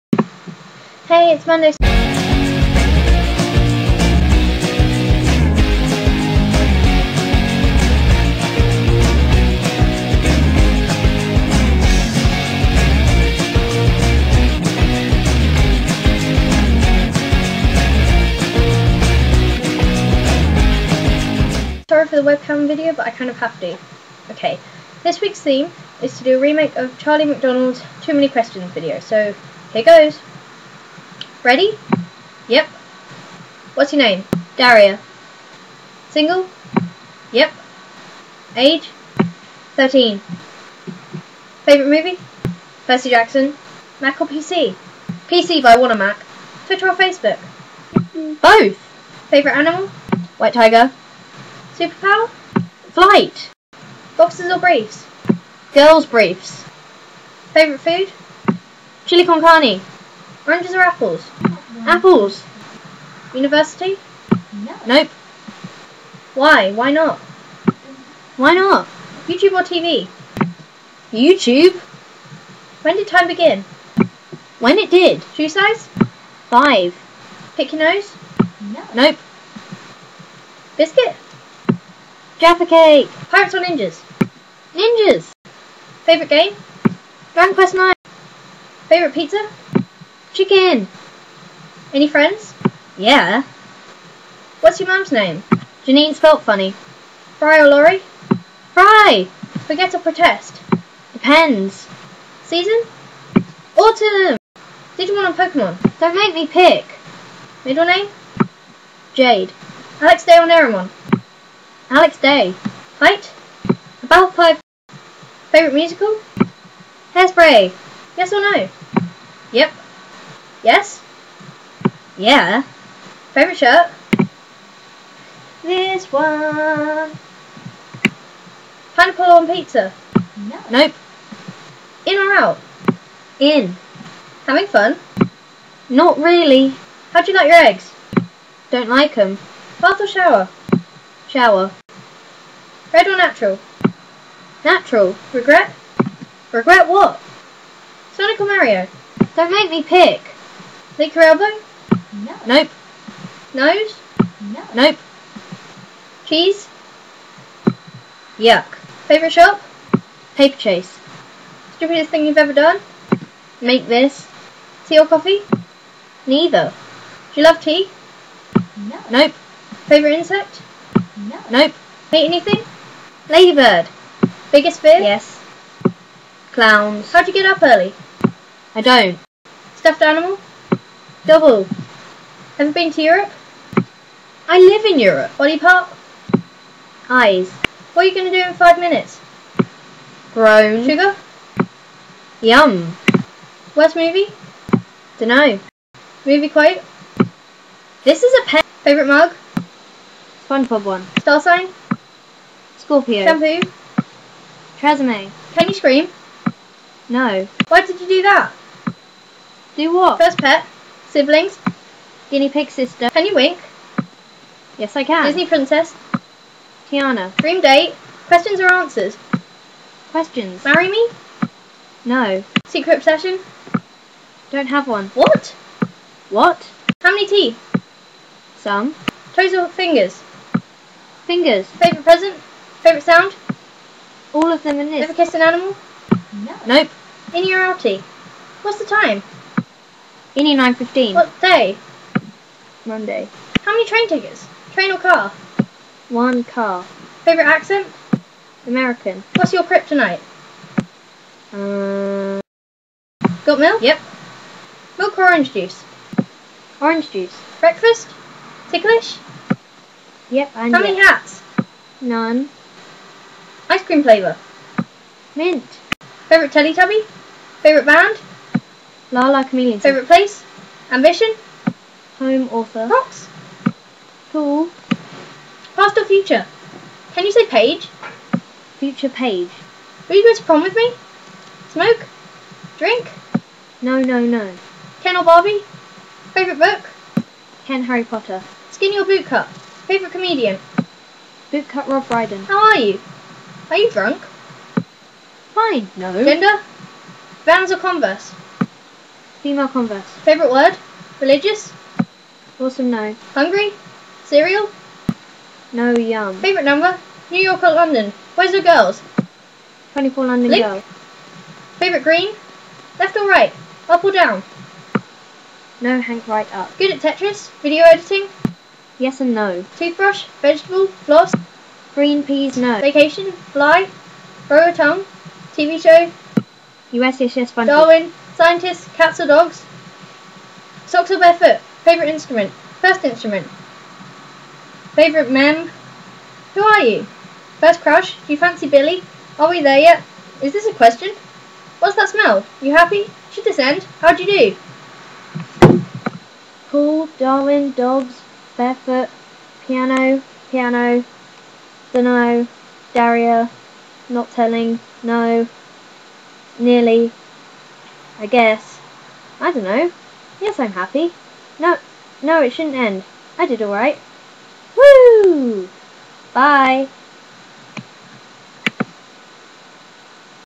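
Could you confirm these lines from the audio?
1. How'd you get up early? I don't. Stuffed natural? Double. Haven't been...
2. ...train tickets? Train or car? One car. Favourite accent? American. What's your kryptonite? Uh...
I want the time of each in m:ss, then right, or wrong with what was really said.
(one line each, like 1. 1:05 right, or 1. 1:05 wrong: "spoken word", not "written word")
1. 2:57 wrong: "animal", not "natural"
2. 4:03 right.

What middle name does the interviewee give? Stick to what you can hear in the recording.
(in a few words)
Jade.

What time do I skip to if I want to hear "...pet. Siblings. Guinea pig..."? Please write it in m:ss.
3:30.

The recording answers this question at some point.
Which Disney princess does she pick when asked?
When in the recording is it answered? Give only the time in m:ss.
3:36.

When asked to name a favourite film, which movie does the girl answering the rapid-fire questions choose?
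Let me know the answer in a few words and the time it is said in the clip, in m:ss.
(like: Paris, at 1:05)
Percy Jackson, at 0:42.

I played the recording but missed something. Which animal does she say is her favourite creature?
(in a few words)
White tiger.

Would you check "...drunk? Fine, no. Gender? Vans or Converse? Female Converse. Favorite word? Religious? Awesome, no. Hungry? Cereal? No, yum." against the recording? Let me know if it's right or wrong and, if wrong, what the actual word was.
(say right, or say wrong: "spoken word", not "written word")
right.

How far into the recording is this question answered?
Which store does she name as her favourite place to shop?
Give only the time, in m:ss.
2:40.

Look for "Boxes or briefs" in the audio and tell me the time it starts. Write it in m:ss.
0:54.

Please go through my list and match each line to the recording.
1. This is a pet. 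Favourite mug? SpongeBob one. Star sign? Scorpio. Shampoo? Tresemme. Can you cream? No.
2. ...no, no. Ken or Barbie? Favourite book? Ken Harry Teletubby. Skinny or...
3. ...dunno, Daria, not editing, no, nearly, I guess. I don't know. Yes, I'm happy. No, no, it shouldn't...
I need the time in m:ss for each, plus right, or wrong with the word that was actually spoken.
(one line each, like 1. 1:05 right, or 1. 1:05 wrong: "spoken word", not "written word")
1. 3:18 wrong: "scream", not "cream"
2. 4:43 wrong: "Potter", not "Teletubby"
3. 5:51 wrong: "telling", not "editing".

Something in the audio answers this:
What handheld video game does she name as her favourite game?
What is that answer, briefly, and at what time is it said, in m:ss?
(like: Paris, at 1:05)
Dragon Quest 9, at 1:27.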